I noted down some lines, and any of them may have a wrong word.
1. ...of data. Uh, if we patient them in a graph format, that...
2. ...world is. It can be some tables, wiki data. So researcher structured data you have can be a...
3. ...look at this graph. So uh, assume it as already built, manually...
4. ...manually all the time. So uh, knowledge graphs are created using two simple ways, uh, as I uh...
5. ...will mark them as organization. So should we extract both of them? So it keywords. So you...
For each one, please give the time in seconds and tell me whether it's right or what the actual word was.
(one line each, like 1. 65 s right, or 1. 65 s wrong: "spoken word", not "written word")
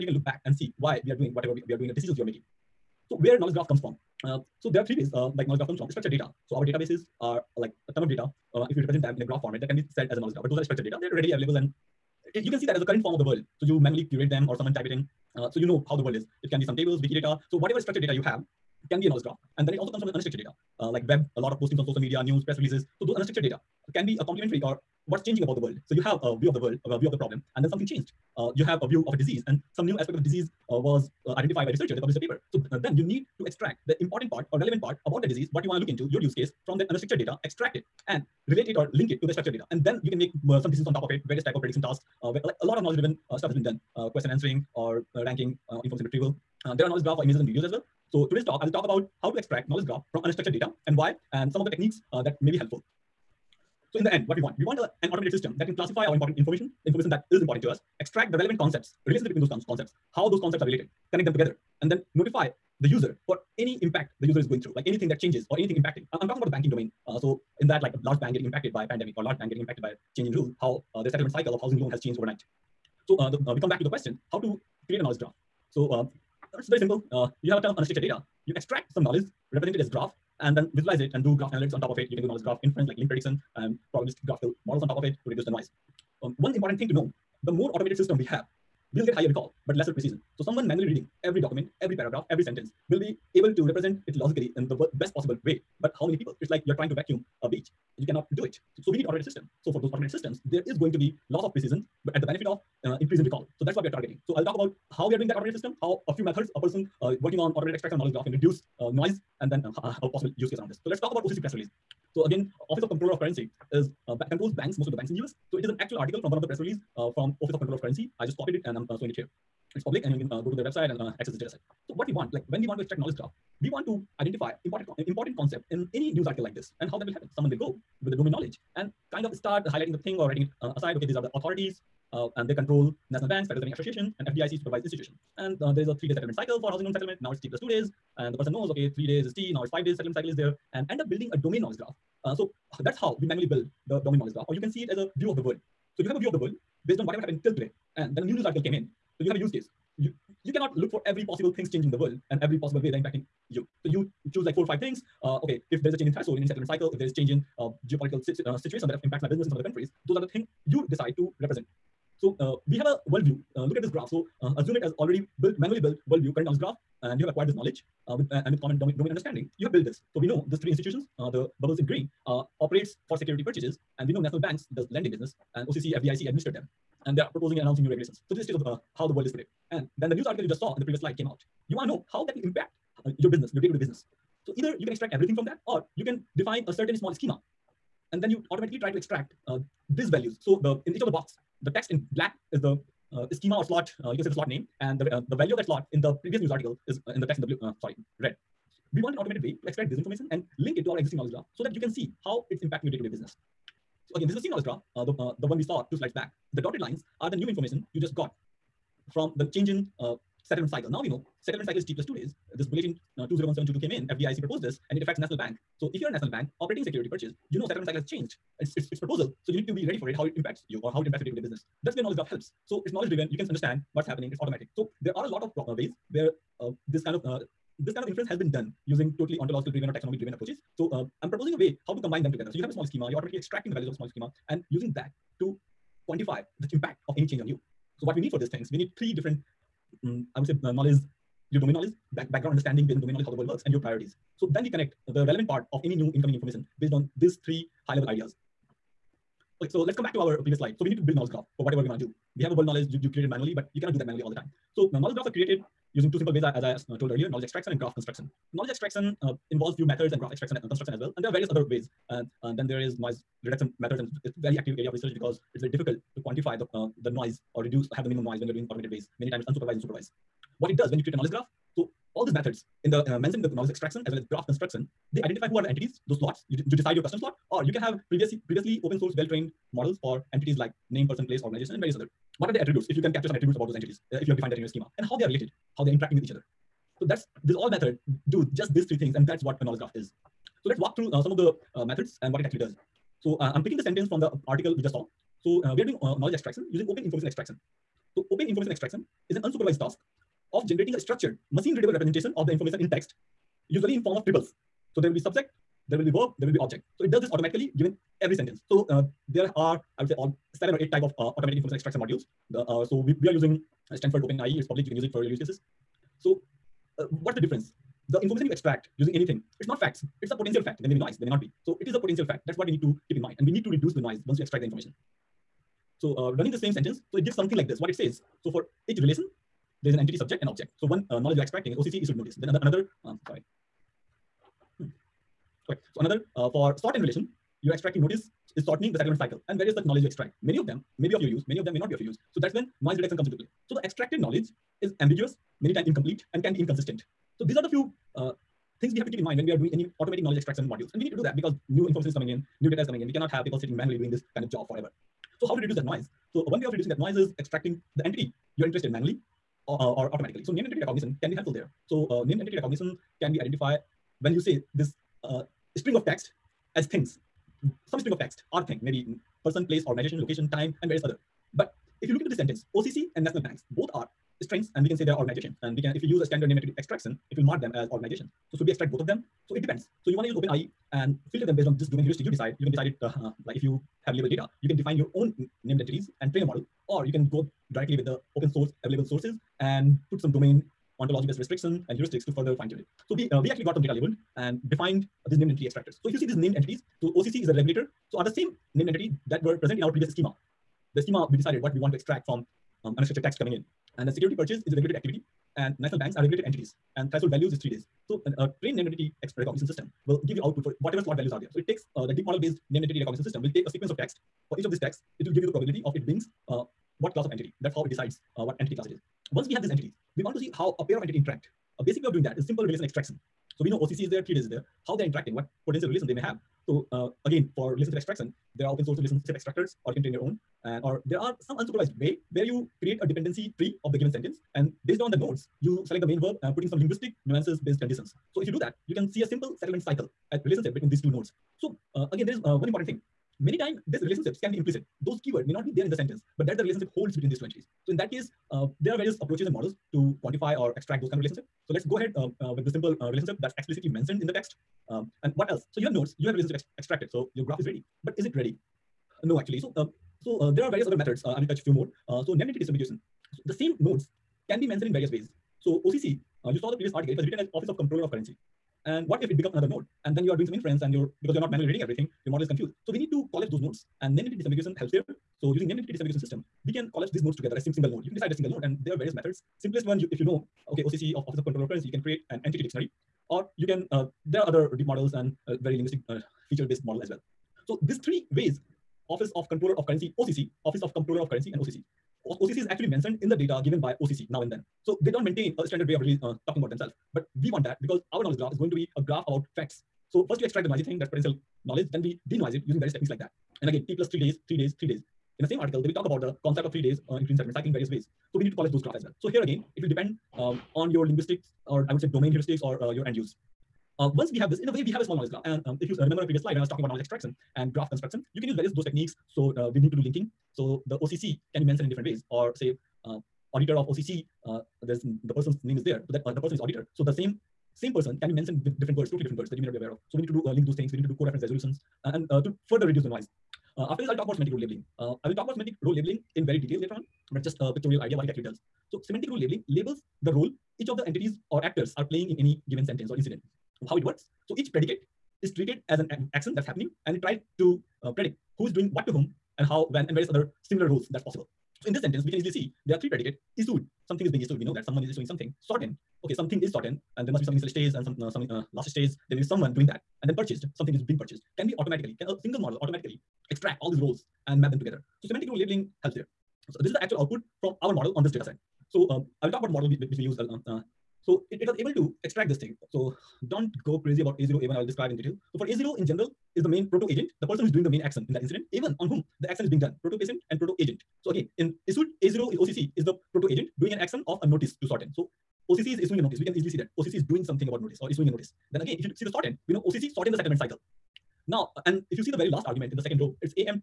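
1. 8 s wrong: "represent", not "patient"
2. 16 s wrong: "whatever", not "researcher"
3. 163 s right
4. 254 s right
5. 377 s wrong: "depends", not "keywords".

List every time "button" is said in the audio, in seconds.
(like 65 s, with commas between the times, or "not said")
not said.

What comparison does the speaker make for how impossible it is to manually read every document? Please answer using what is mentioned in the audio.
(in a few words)
Vacuum a beach.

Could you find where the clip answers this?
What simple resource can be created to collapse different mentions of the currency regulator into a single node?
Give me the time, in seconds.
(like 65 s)
482 s.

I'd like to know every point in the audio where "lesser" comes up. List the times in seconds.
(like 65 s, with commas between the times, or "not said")
89 s.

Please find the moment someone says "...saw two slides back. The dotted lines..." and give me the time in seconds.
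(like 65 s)
205 s.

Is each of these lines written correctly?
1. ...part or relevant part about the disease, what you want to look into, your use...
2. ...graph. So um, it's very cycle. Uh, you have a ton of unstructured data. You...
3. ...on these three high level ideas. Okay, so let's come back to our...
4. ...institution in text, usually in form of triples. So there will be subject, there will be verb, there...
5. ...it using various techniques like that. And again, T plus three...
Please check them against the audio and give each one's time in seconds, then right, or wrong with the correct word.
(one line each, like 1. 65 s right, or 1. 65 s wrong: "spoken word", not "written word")
1. 34 s right
2. 75 s wrong: "simple", not "cycle"
3. 246 s right
4. 302 s wrong: "information", not "institution"
5. 502 s right.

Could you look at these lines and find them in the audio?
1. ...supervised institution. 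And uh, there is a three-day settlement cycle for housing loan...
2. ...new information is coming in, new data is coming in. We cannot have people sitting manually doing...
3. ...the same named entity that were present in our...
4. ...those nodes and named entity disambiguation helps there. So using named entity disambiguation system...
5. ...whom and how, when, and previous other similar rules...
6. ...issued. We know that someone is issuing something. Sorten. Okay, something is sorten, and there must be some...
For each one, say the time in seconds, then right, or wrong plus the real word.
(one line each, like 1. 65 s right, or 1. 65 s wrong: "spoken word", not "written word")
1. 134 s right
2. 351 s right
3. 398 s right
4. 473 s right
5. 549 s wrong: "various", not "previous"
6. 554 s right.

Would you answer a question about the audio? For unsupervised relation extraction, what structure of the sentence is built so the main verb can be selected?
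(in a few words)
Dependency tree.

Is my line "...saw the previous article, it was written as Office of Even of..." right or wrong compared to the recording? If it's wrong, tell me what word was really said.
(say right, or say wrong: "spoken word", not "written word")
wrong: "Controller", not "Even".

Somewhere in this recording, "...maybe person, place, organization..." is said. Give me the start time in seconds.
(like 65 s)
368 s.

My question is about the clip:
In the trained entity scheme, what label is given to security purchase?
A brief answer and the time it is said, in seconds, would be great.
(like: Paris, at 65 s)
Regulated activity, at 404 s.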